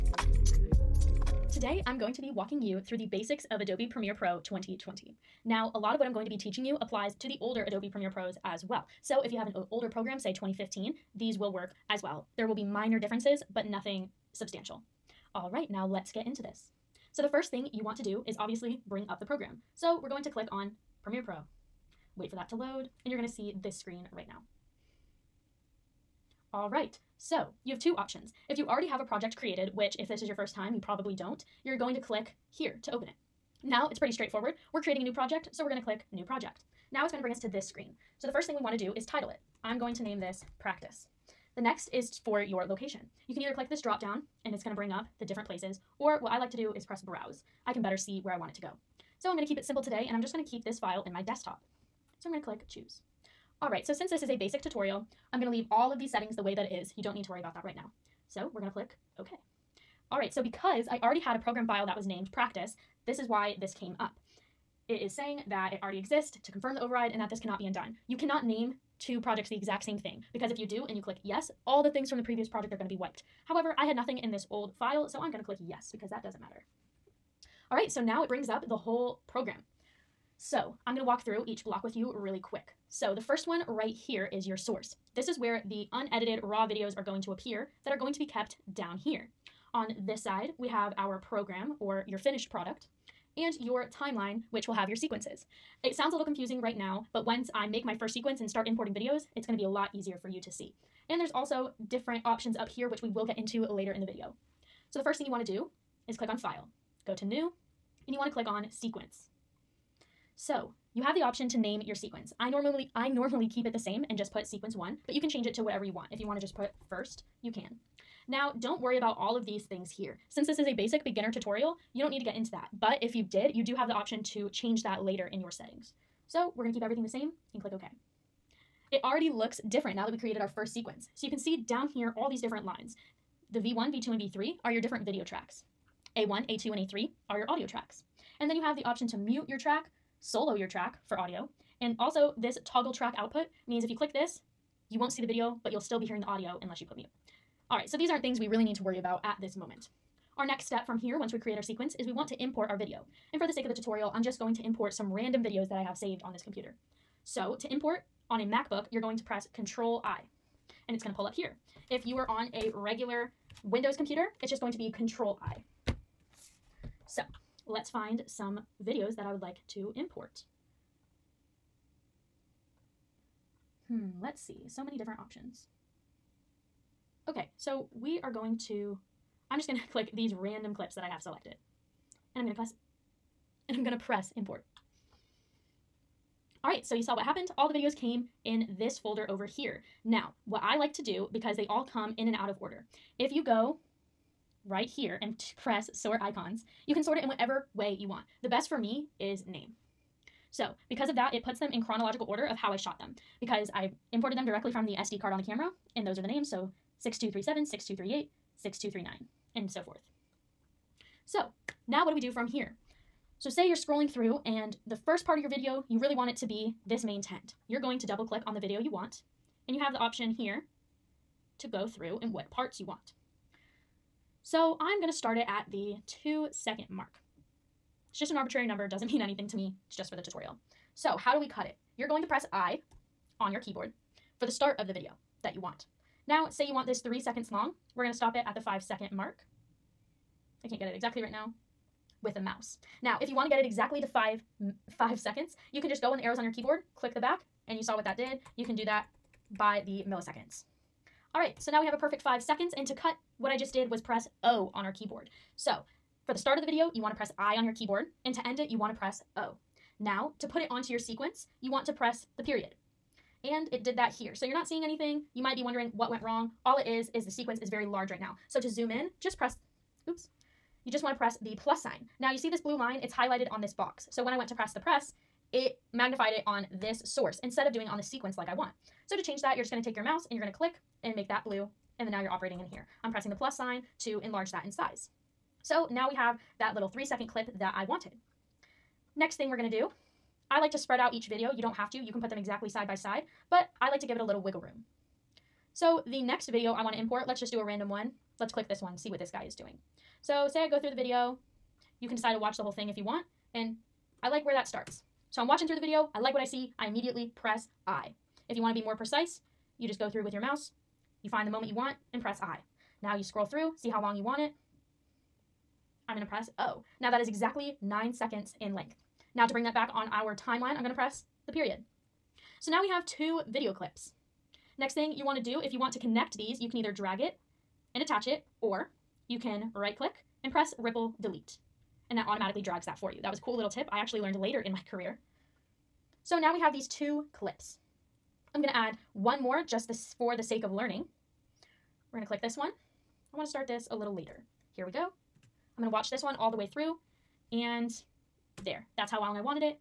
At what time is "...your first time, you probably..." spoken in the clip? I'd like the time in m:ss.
0:30.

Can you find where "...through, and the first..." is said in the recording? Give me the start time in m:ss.
3:34.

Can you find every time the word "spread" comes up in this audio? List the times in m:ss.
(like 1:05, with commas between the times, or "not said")
4:50.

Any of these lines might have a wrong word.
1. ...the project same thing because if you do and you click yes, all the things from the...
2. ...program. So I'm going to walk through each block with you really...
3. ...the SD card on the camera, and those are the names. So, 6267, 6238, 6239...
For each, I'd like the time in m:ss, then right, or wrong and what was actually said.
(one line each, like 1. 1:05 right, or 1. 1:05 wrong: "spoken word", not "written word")
1. 1:09 wrong: "exact", not "project"
2. 1:19 right
3. 3:24 wrong: "6237", not "6267".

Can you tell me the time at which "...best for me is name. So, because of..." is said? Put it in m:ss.
3:18.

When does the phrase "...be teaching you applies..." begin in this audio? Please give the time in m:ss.
0:06.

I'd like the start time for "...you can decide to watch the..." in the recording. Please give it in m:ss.
5:02.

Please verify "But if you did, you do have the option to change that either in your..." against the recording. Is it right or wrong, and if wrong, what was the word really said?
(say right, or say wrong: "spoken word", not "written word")
wrong: "later", not "either".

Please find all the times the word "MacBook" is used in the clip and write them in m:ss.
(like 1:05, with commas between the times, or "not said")
2:38.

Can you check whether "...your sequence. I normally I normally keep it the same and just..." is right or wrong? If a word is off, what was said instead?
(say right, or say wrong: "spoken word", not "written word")
right.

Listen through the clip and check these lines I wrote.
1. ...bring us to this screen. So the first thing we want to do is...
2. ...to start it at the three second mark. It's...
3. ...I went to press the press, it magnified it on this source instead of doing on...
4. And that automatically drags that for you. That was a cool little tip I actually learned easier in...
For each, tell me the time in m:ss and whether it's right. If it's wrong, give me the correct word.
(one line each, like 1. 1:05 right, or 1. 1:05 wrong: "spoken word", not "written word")
1. 0:37 right
2. 3:45 wrong: "two", not "three"
3. 4:34 right
4. 5:32 wrong: "later", not "easier".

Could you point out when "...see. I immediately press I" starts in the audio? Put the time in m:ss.
5:06.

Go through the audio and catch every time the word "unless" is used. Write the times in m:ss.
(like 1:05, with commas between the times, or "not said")
2:26.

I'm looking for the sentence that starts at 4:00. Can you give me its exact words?
I can't get it exactly right now with the mouse.